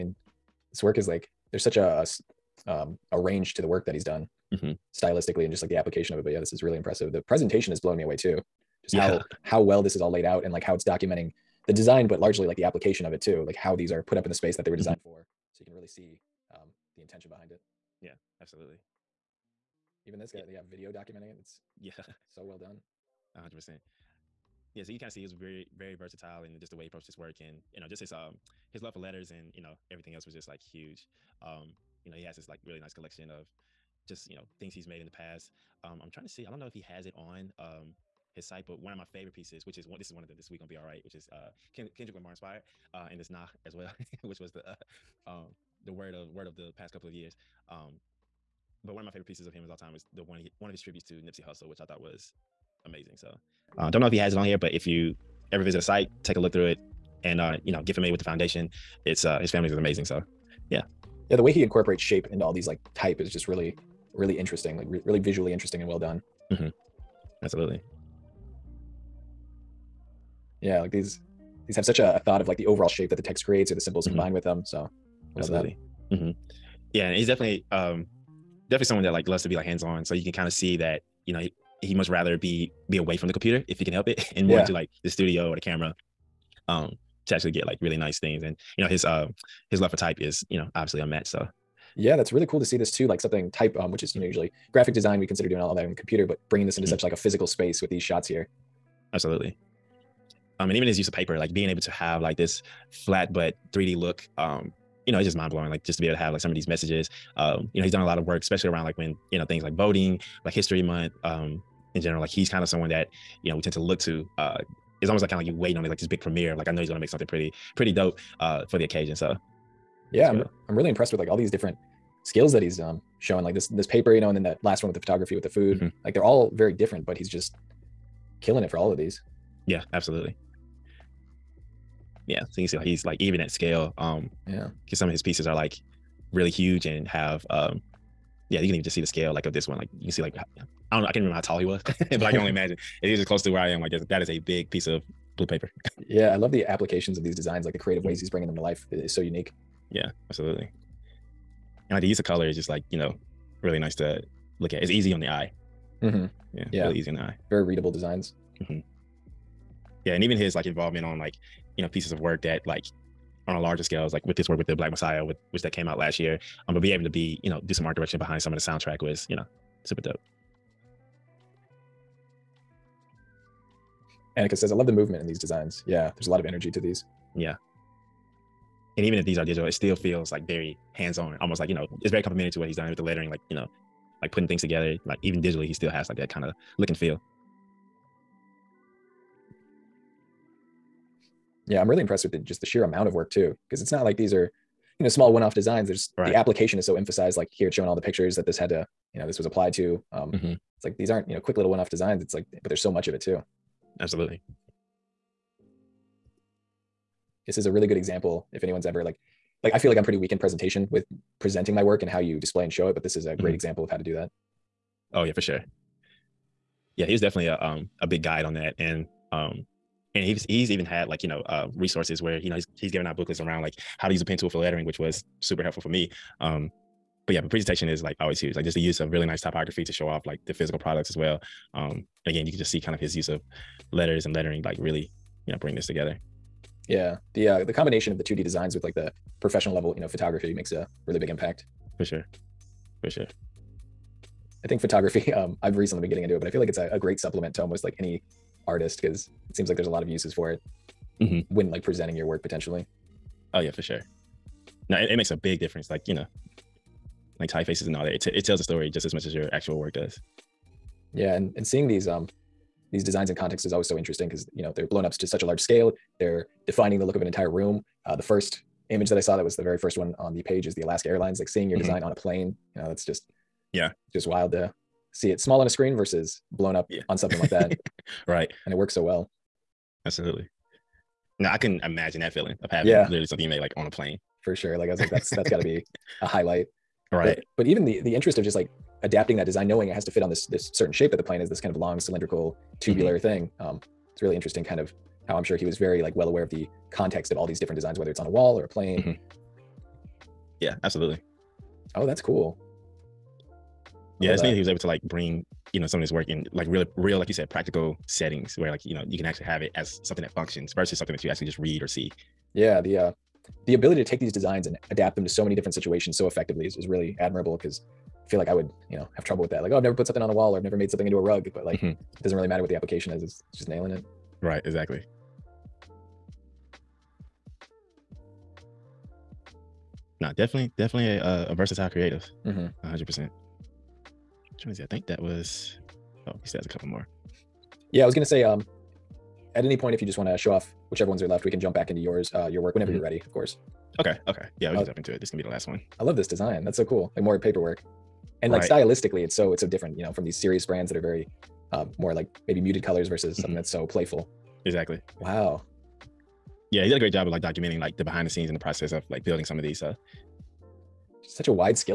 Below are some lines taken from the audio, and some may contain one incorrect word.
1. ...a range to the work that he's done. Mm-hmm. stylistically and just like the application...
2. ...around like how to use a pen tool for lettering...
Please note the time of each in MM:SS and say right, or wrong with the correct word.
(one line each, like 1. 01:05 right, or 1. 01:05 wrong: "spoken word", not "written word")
1. 00:03 right
2. 03:43 right.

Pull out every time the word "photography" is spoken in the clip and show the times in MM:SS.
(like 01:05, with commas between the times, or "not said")
02:04, 04:00, 04:04.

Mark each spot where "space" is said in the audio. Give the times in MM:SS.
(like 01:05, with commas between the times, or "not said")
00:14, 01:37.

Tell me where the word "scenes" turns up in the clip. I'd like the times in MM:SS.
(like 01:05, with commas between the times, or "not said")
05:58.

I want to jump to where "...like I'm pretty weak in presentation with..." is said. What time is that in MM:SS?
03:29.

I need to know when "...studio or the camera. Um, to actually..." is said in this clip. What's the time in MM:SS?
01:25.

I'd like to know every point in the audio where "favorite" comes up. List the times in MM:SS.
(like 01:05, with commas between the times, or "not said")
00:39, 00:49.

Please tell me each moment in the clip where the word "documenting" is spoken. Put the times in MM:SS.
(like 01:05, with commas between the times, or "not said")
00:10, 00:20, 05:57.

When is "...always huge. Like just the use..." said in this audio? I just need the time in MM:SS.
03:48.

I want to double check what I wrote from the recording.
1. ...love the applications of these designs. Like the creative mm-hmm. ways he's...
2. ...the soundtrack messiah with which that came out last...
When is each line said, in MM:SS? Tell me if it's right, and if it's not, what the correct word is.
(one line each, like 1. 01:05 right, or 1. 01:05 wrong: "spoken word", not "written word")
1. 02:26 right
2. 02:44 wrong: "black", not "soundtrack".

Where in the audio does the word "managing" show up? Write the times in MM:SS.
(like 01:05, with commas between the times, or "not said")
not said.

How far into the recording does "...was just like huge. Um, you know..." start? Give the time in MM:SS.
00:30.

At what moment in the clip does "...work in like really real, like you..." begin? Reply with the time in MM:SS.
05:06.